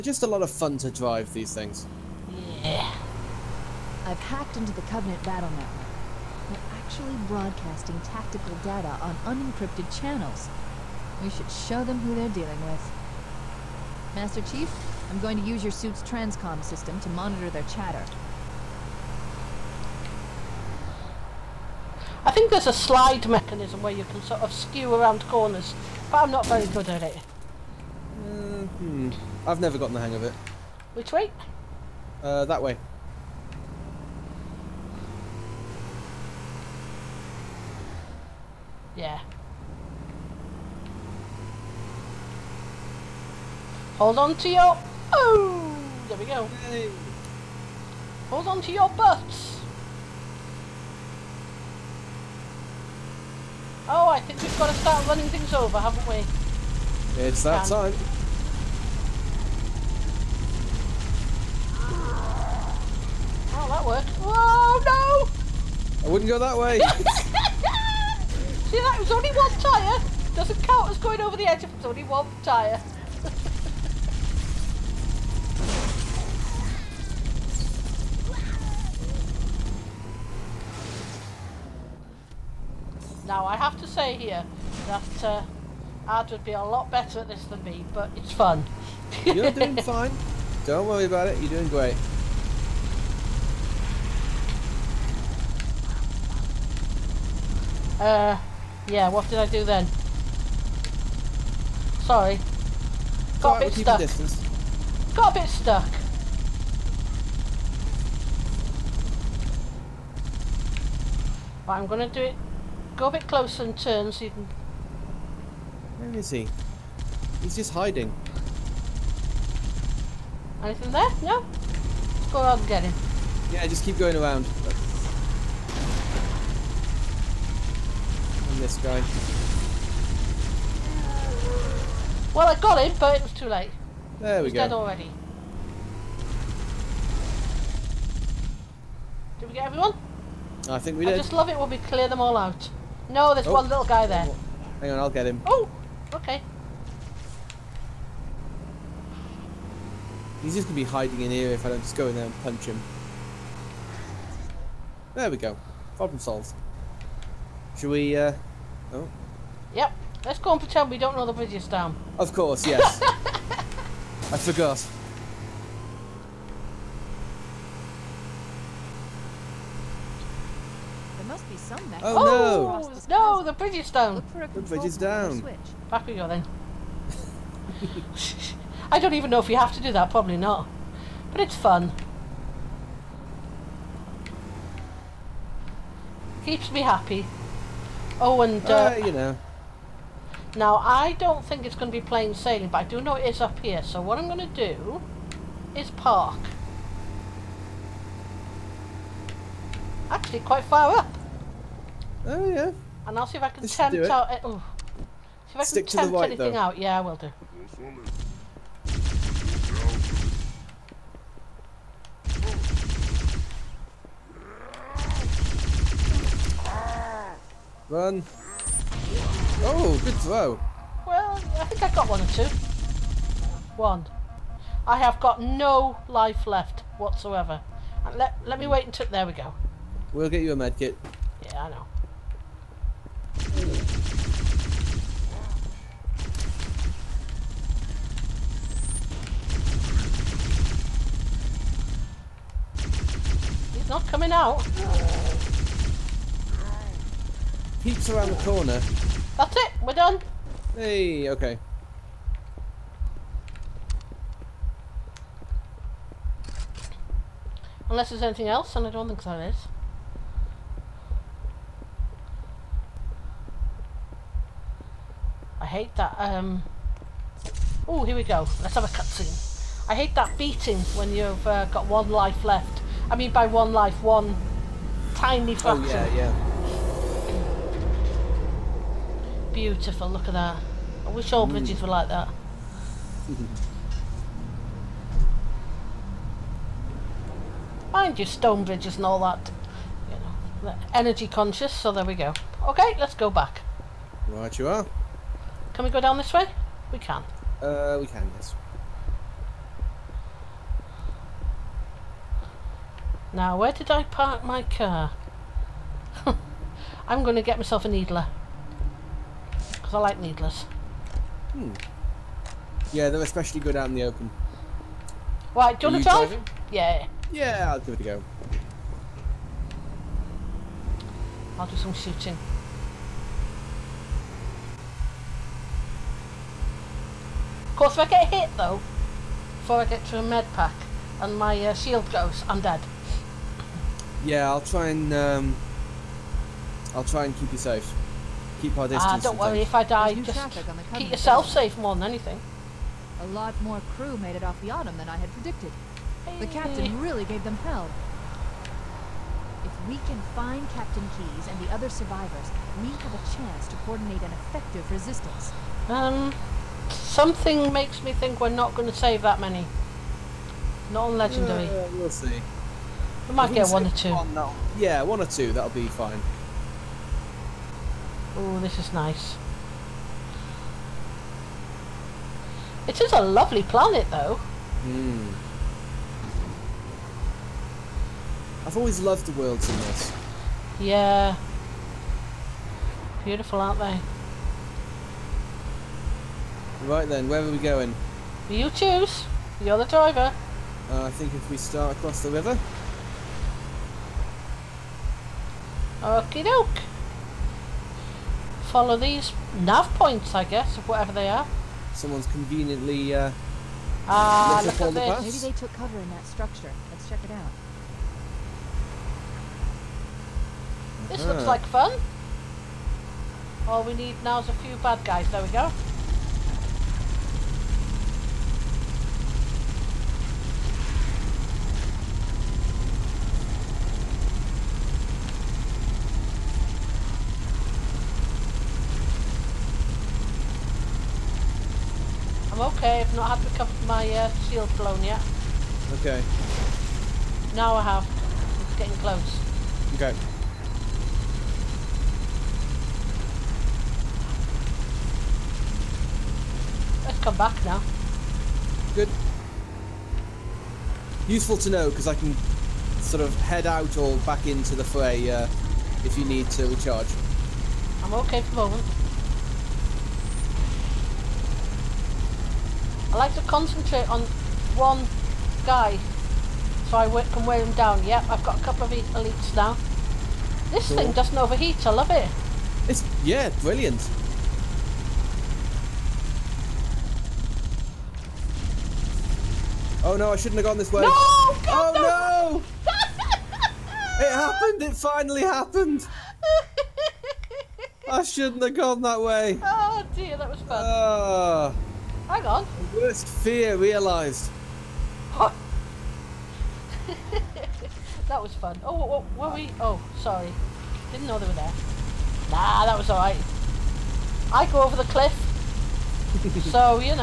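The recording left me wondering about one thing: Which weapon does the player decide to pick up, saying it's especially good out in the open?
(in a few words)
needler.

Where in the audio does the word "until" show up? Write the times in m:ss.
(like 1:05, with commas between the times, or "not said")
3:48.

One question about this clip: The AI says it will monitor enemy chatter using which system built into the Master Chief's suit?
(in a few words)
transcom system.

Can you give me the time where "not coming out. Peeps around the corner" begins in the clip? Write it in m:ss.
4:03.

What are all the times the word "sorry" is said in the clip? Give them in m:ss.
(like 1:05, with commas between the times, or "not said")
1:42, 8:20.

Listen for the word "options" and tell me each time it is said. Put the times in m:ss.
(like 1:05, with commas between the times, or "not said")
not said.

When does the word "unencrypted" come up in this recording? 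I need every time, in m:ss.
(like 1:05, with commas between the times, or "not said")
0:09.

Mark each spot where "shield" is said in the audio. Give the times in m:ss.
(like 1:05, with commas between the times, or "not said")
5:31, 7:14.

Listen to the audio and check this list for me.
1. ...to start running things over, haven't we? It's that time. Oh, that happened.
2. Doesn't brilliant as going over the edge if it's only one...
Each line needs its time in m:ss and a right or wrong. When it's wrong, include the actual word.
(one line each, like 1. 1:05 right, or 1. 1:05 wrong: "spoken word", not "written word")
1. 0:54 wrong: "worked", not "happened"
2. 1:10 wrong: "count", not "brilliant".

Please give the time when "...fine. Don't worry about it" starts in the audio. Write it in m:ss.
1:29.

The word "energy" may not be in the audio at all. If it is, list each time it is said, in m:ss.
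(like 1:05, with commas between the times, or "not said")
4:50.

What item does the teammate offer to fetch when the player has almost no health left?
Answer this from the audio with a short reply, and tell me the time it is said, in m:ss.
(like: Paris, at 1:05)
a medkit, at 3:50.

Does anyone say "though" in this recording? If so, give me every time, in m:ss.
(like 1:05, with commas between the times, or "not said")
3:26, 5:28, 6:14.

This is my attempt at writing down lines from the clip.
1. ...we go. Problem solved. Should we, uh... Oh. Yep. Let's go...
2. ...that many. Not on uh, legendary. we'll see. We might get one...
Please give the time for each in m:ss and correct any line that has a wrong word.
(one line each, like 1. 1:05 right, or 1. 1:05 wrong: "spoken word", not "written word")
1. 2:35 right
2. 5:59 right.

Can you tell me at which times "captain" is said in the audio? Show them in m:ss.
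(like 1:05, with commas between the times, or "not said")
5:46, 5:50.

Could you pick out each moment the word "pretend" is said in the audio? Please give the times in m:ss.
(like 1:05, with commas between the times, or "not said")
2:40.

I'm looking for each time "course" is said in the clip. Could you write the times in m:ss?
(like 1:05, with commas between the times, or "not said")
2:42, 5:27.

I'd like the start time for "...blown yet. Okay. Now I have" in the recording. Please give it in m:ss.
7:14.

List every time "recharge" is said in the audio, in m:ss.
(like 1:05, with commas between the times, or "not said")
7:36.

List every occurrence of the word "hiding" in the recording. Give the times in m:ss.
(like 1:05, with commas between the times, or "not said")
1:57, 2:30.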